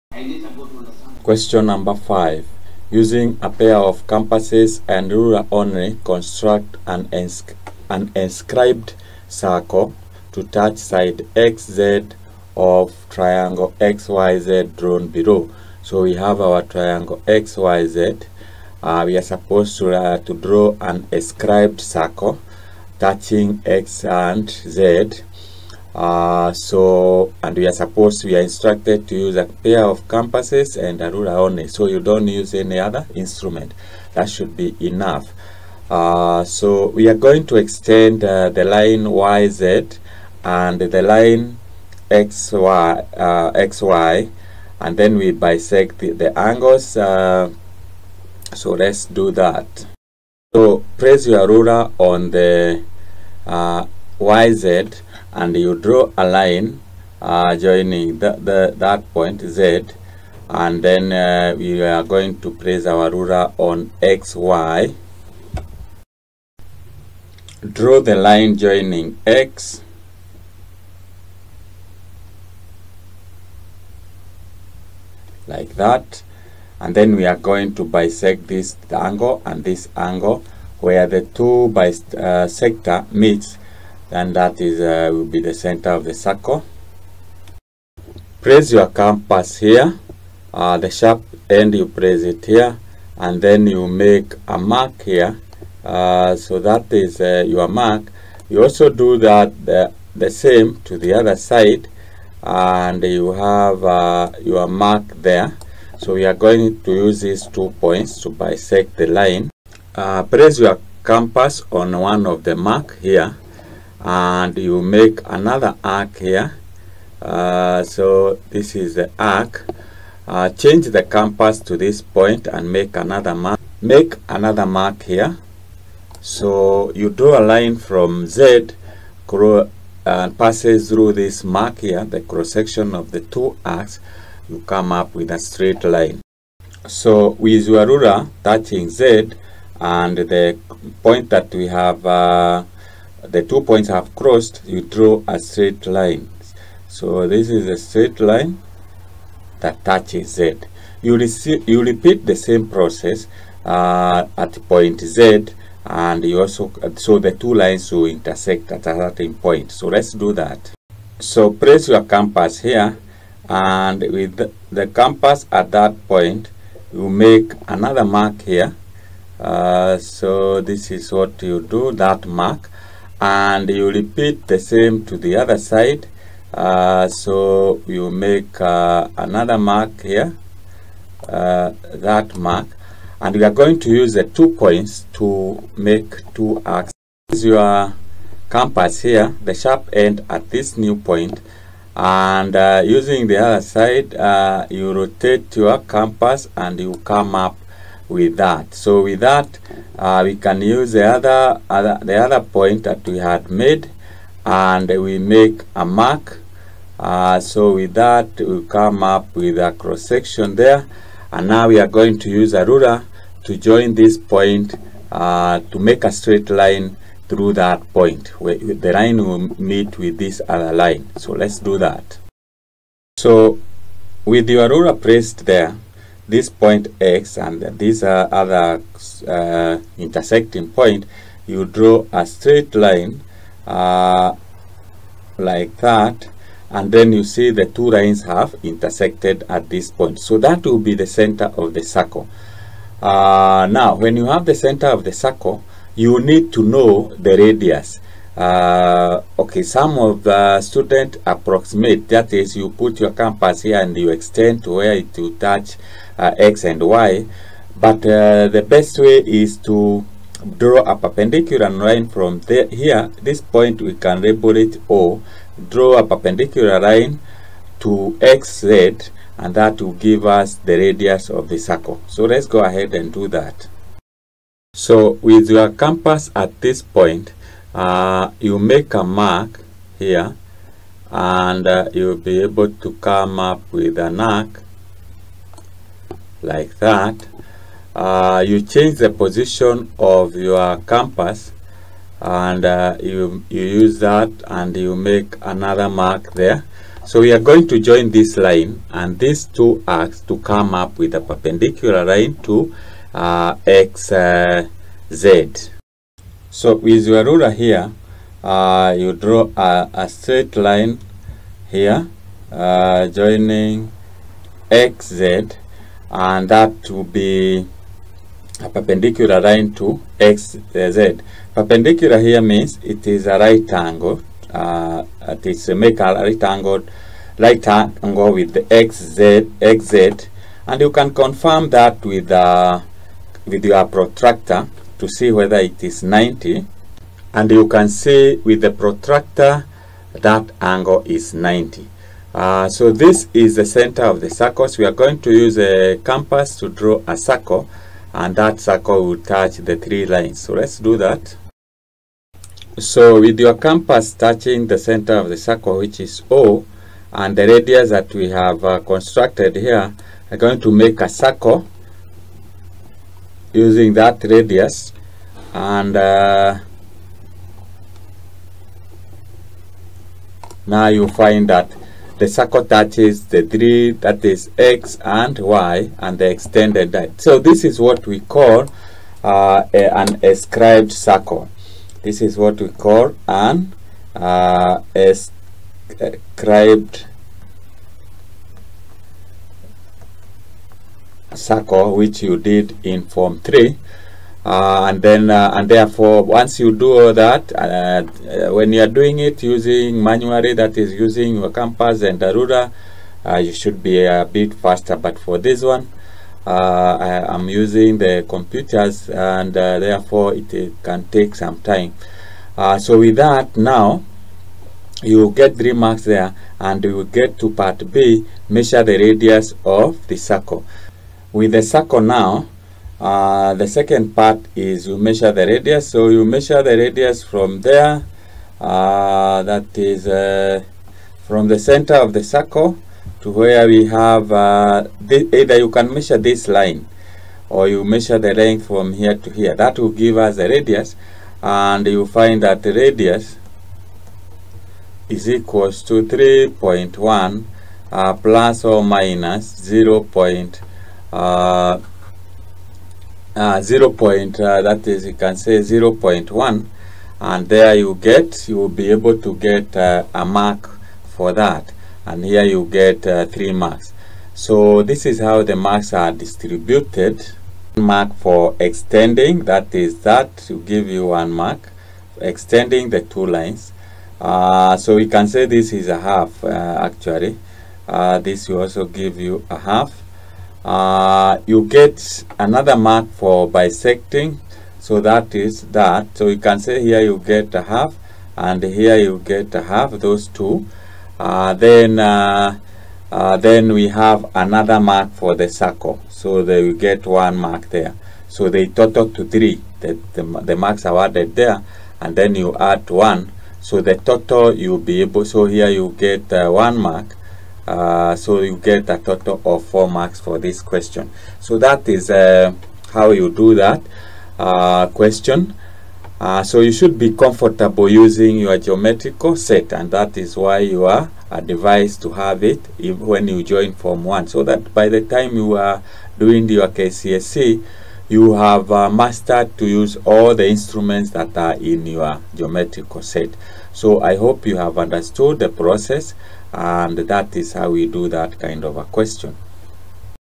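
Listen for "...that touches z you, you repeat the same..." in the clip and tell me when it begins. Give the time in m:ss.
2:29.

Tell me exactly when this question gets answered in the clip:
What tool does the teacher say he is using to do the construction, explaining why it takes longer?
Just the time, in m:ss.
6:48.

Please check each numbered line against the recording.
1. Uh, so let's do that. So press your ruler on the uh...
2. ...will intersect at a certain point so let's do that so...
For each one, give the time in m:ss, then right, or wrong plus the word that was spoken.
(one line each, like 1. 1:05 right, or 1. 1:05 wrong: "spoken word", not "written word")
1. 0:46 right
2. 2:37 right.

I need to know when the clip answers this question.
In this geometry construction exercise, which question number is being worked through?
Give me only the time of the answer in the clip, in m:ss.
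0:01.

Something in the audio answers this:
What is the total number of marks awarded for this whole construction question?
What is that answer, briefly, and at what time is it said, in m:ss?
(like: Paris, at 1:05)
4, at 8:29.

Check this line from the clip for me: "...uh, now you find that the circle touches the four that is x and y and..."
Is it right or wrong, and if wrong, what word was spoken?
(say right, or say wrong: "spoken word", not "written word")
wrong: "three", not "four".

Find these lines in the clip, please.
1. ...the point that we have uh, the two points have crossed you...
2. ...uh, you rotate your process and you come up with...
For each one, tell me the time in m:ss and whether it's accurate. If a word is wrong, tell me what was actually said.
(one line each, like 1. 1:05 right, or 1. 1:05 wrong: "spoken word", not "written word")
1. 2:20 right
2. 3:14 wrong: "compass", not "process".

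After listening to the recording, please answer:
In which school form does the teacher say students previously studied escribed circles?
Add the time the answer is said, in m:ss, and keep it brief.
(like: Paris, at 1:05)
Form 3, at 6:33.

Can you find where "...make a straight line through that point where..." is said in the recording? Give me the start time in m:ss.
3:35.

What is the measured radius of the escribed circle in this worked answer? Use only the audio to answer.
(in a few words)
3.1.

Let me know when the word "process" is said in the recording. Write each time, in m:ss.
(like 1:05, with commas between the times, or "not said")
2:32, 8:55.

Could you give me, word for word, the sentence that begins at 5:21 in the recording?
Perpendicular here means it is a right angle.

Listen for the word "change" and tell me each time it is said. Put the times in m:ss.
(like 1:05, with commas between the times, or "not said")
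2:00, 4:48.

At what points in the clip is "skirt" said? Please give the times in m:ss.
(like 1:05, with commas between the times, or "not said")
not said.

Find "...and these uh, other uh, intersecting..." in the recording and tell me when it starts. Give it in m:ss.
3:47.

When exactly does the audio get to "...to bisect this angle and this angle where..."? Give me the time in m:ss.
1:17.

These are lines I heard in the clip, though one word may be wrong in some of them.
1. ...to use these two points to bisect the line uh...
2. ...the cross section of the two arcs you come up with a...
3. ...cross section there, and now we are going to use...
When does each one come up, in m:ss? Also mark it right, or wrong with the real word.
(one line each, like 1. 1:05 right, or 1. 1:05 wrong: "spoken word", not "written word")
1. 1:46 right
2. 2:12 right
3. 3:29 right.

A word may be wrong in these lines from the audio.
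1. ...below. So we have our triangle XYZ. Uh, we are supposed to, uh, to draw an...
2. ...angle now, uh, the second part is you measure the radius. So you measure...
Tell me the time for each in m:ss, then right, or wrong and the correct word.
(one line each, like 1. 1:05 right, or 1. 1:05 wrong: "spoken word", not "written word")
1. 0:15 right
2. 7:01 wrong: "circle", not "angle".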